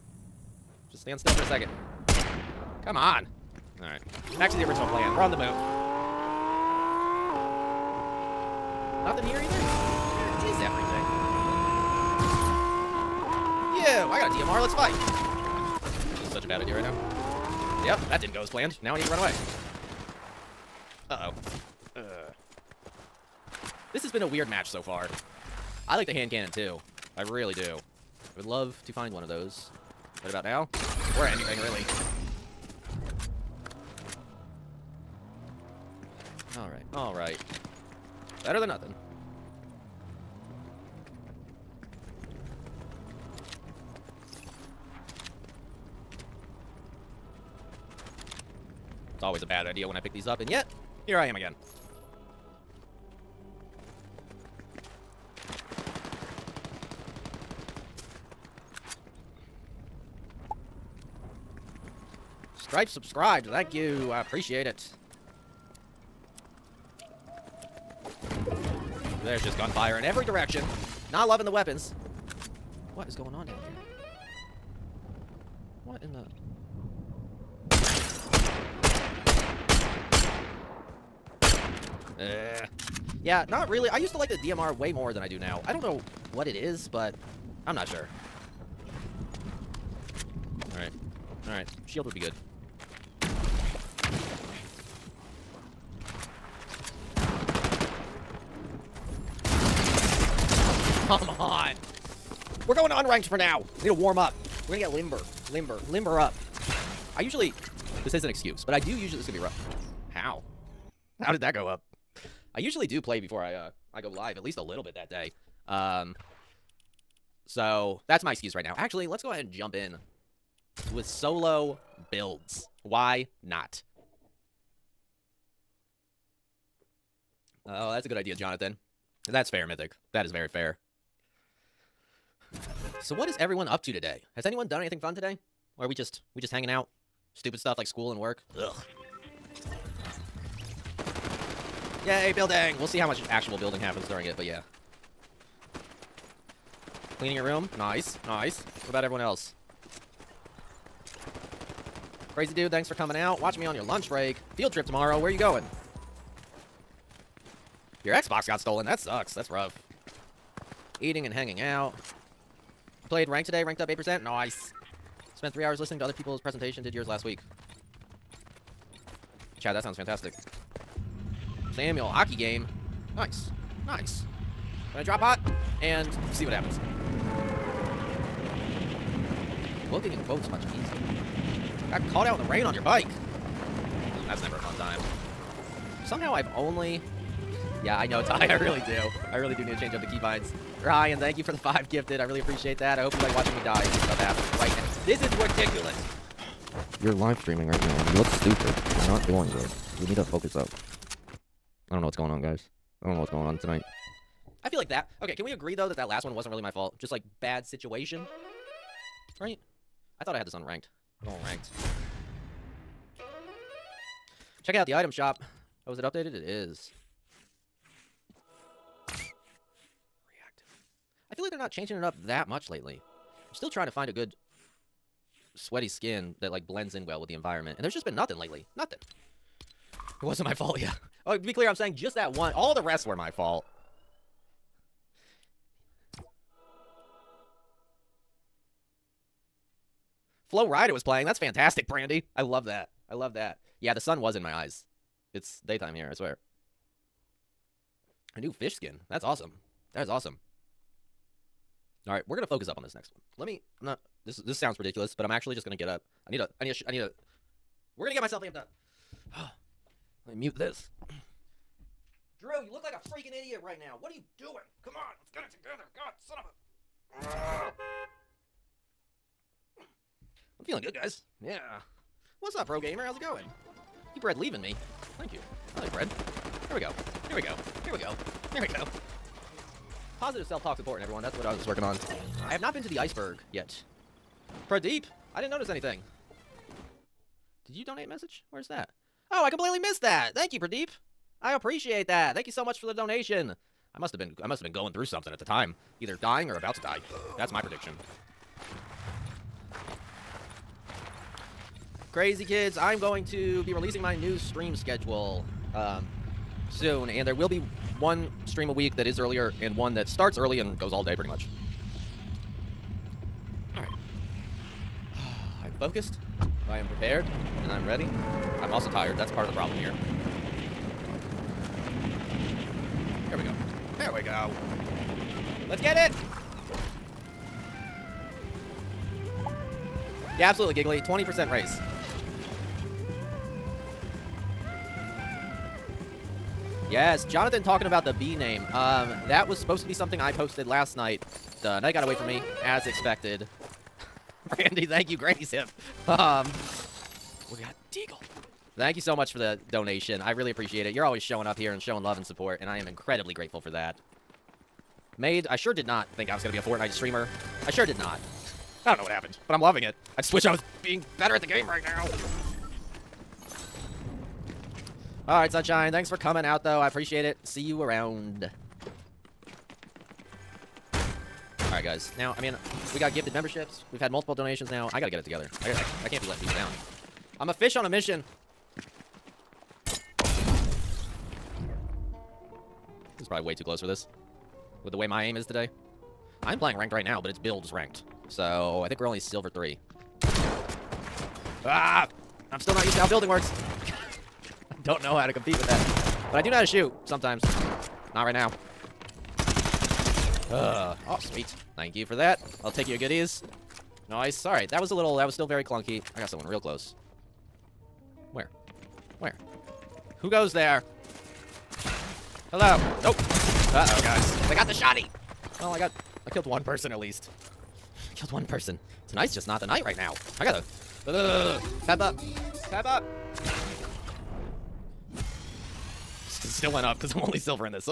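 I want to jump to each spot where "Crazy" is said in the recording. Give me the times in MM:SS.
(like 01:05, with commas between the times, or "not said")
02:32, 05:02.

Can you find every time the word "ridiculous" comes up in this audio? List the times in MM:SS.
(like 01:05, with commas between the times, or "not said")
03:15, 04:14.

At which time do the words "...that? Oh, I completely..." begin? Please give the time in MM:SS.
04:48.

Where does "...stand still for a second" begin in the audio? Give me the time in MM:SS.
00:01.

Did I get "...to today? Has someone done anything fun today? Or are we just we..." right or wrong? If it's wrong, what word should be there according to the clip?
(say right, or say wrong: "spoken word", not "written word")
wrong: "anyone", not "someone".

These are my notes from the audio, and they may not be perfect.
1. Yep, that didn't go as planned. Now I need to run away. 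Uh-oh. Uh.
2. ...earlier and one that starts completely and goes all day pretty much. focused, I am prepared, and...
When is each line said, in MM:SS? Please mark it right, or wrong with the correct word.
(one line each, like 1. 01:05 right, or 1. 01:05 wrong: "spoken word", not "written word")
1. 00:17 right
2. 05:09 wrong: "early", not "completely".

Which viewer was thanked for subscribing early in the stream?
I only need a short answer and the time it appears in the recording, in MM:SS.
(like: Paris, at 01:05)
Stripe, at 01:02.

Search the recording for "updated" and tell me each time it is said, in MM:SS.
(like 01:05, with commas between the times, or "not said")
03:36.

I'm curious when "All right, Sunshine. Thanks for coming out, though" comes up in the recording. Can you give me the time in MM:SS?
06:05.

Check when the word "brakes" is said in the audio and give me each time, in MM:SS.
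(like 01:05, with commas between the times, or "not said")
not said.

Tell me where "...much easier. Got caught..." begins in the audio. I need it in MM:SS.
03:00.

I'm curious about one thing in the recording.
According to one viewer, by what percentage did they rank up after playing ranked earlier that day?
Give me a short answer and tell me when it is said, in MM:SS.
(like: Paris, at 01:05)
8%, at 02:43.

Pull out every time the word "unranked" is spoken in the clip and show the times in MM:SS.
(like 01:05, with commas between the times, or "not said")
01:42, 03:30.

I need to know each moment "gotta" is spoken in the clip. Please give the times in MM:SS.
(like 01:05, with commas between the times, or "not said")
06:14, 07:00.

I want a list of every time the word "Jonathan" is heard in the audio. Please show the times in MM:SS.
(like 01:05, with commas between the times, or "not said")
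02:08, 05:37.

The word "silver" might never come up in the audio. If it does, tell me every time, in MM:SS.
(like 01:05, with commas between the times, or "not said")
06:29, 07:07.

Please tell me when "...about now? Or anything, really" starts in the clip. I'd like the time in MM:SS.
00:30.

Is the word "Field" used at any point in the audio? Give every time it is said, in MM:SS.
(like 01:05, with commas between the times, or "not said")
02:34.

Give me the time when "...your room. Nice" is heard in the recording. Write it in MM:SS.
02:27.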